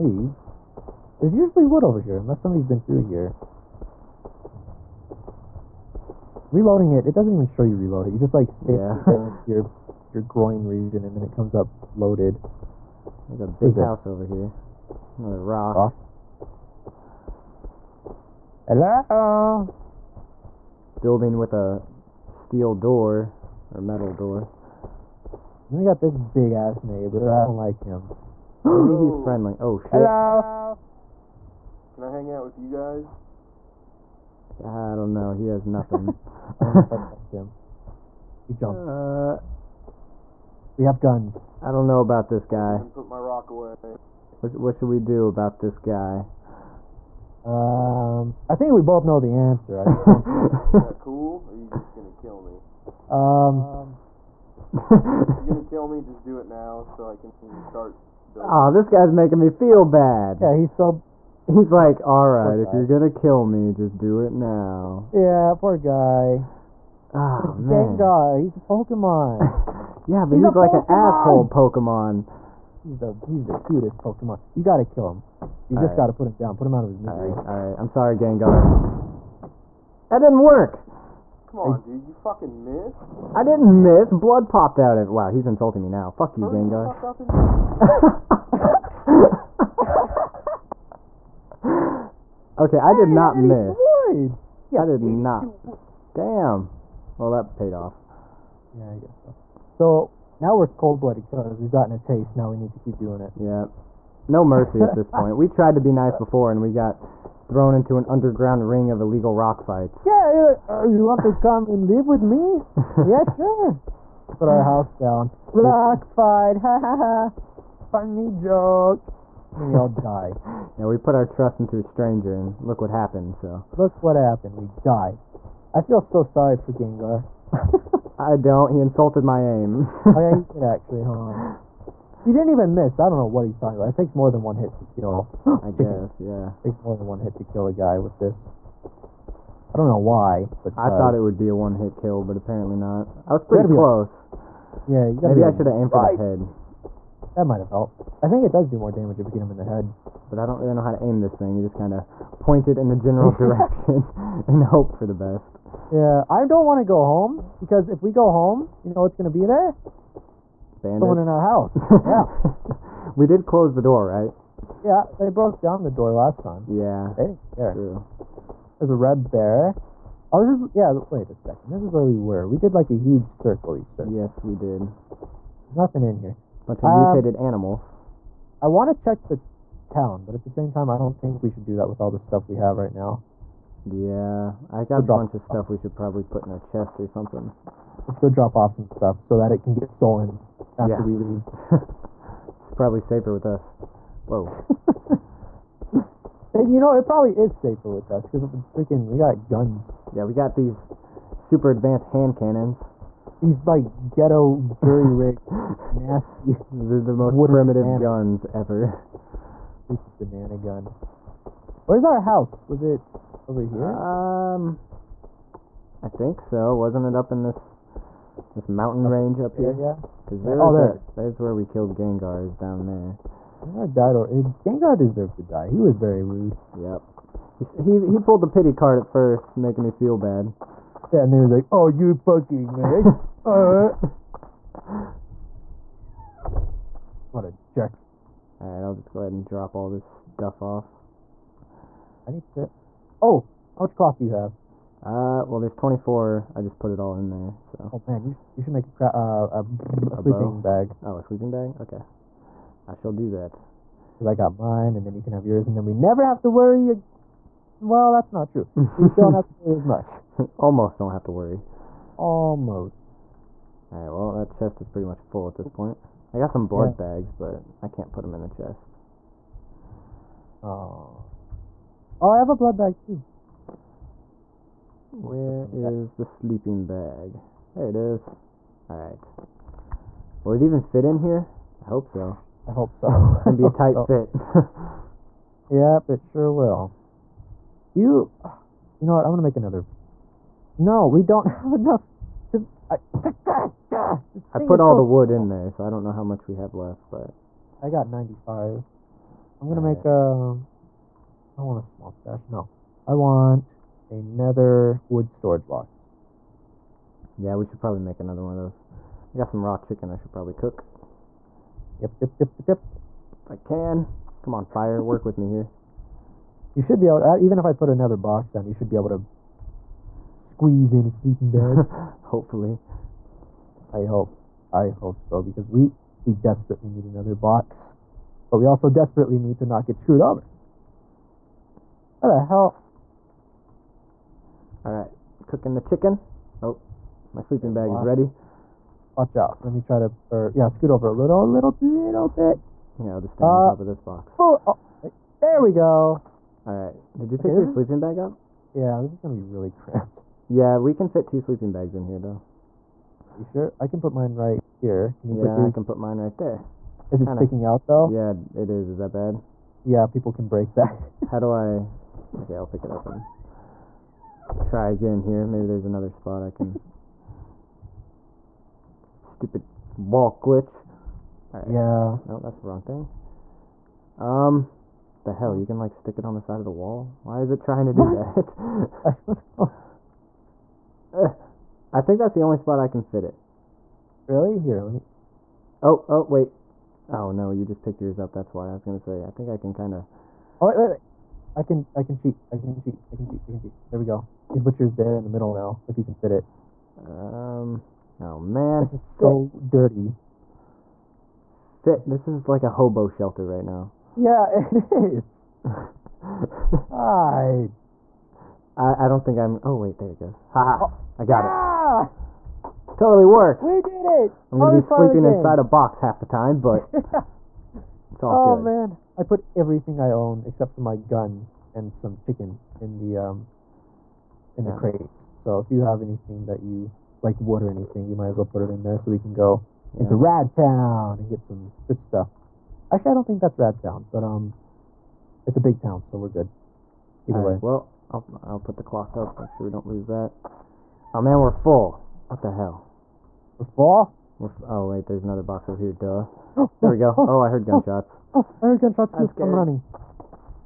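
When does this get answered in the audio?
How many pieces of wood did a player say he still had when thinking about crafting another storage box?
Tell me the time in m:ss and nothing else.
4:58.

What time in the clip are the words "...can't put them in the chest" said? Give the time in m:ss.
4:27.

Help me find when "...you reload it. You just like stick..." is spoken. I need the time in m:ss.
0:07.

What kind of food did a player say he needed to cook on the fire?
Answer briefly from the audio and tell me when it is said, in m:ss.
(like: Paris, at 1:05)
Raw chicken, at 5:09.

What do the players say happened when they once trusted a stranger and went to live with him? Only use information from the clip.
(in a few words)
Underground ring of illegal rock fights.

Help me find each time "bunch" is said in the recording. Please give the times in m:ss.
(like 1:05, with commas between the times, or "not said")
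2:56, 3:05.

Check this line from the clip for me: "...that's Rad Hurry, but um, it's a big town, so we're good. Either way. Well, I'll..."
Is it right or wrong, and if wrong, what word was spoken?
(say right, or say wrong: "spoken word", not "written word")
wrong: "Town", not "Hurry".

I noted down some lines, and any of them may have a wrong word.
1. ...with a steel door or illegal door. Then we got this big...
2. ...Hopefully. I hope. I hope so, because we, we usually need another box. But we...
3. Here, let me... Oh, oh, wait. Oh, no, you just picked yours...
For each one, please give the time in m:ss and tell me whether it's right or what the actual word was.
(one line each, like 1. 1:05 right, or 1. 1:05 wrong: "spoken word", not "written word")
1. 0:21 wrong: "metal", not "illegal"
2. 5:22 wrong: "desperately", not "usually"
3. 6:24 right.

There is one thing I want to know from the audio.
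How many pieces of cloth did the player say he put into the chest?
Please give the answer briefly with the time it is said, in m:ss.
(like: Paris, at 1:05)
24, at 4:05.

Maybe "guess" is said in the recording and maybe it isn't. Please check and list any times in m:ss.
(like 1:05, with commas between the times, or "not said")
1:39, 2:16.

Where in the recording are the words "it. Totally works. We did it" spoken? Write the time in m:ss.
6:52.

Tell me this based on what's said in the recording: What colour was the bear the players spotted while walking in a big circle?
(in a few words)
Red.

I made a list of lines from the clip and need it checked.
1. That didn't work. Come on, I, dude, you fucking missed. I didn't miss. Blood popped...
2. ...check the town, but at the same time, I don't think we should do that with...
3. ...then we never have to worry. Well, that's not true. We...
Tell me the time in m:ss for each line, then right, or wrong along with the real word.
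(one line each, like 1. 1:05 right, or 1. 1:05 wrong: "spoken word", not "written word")
1. 1:20 right
2. 2:58 right
3. 4:15 right.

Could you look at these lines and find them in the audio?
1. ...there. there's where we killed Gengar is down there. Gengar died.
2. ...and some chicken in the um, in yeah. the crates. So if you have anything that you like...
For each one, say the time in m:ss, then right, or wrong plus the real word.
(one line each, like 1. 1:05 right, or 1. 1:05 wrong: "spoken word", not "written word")
1. 3:40 right
2. 7:01 right.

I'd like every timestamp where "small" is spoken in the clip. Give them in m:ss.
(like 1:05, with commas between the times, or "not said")
4:55, 5:01.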